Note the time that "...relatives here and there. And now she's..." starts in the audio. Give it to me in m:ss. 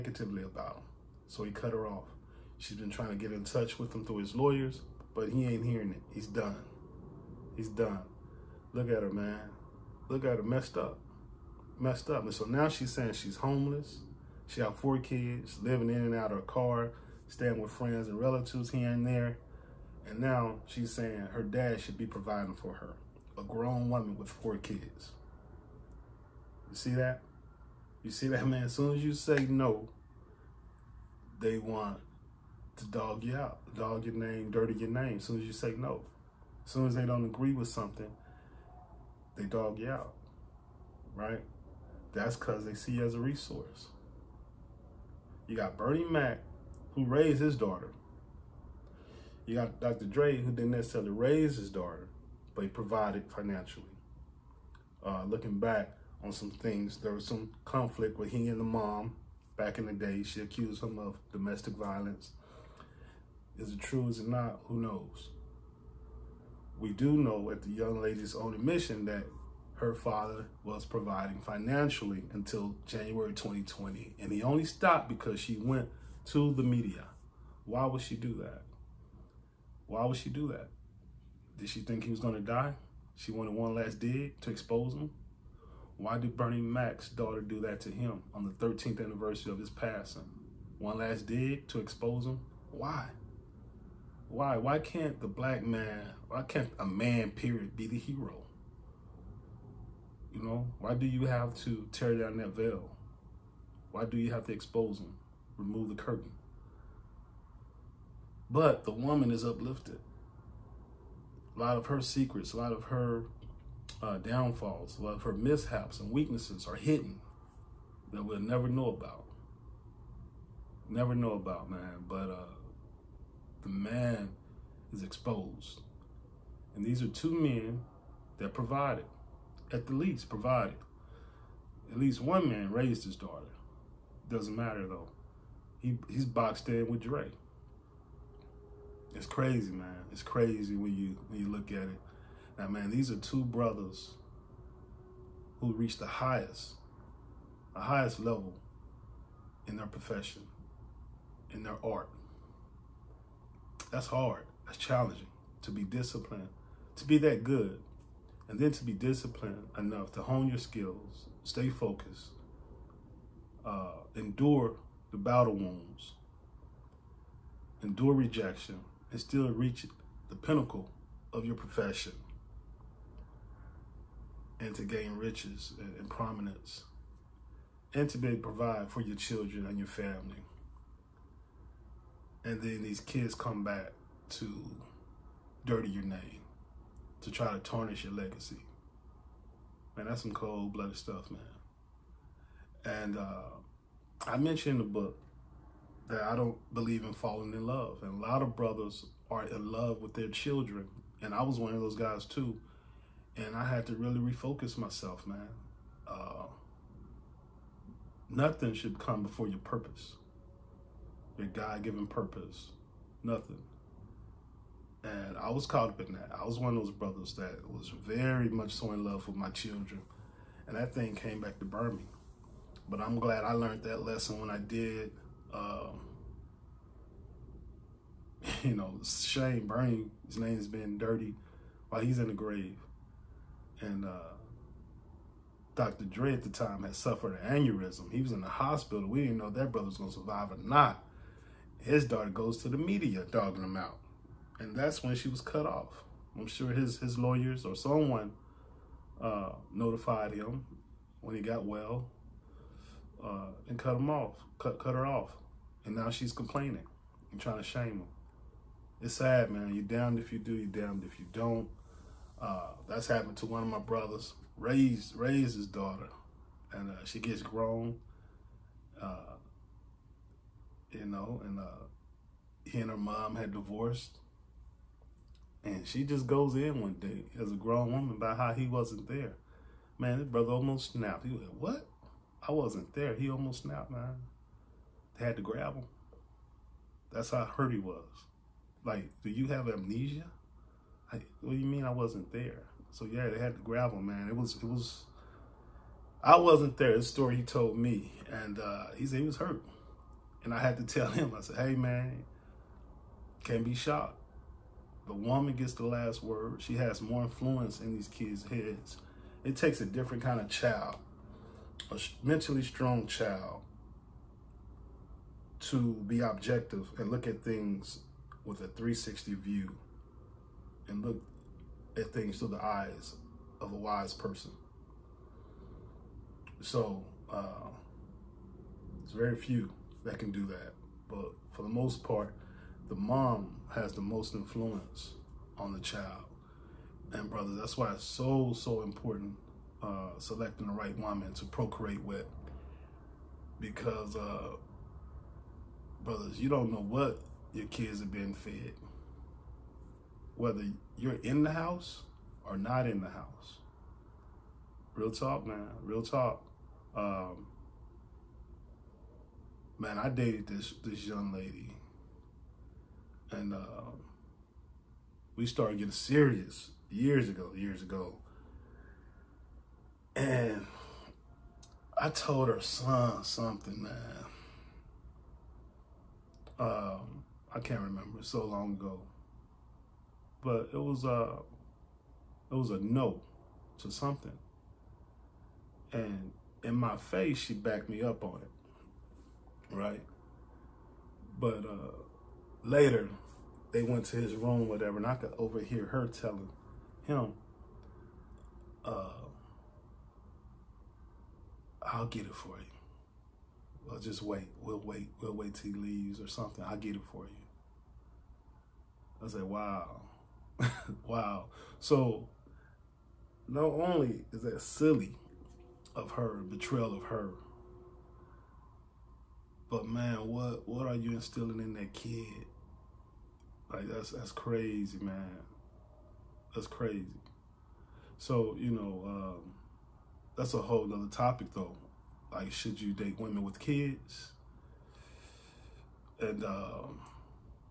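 0:18.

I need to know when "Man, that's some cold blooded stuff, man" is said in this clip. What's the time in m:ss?
3:09.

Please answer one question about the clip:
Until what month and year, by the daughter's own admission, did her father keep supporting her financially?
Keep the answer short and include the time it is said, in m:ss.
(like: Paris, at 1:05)
January 2020, at 1:12.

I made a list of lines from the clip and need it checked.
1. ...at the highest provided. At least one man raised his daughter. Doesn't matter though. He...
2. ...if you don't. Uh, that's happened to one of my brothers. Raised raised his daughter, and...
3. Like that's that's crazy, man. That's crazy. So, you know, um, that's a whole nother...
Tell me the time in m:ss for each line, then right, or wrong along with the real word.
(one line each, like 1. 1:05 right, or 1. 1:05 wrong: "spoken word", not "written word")
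1. 2:09 wrong: "least", not "highest"
2. 4:21 right
3. 7:03 right.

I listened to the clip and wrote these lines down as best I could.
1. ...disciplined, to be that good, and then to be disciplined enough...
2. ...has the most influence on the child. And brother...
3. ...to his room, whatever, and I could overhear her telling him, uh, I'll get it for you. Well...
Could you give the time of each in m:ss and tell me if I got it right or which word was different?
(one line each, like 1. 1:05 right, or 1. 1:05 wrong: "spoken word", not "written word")
1. 2:35 right
2. 5:33 right
3. 6:34 right.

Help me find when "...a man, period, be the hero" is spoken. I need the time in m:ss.
1:36.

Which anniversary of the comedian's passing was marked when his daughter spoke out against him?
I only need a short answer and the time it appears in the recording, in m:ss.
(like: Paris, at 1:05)
13th, at 1:28.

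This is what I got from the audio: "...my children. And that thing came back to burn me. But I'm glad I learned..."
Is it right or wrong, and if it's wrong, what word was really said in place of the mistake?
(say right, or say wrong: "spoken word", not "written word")
right.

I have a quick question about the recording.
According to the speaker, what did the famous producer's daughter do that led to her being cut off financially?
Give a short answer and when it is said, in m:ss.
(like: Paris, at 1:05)
Went to the media, at 1:15.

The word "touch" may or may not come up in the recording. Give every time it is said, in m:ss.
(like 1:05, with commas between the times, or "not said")
0:03.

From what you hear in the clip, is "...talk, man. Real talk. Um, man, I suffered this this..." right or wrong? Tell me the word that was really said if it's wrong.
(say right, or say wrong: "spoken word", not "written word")
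wrong: "dated", not "suffered".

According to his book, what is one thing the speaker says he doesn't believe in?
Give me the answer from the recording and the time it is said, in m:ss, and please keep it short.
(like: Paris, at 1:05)
Falling in love, at 3:17.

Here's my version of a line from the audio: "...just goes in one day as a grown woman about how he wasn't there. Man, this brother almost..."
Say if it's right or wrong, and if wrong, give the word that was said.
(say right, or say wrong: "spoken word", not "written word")
right.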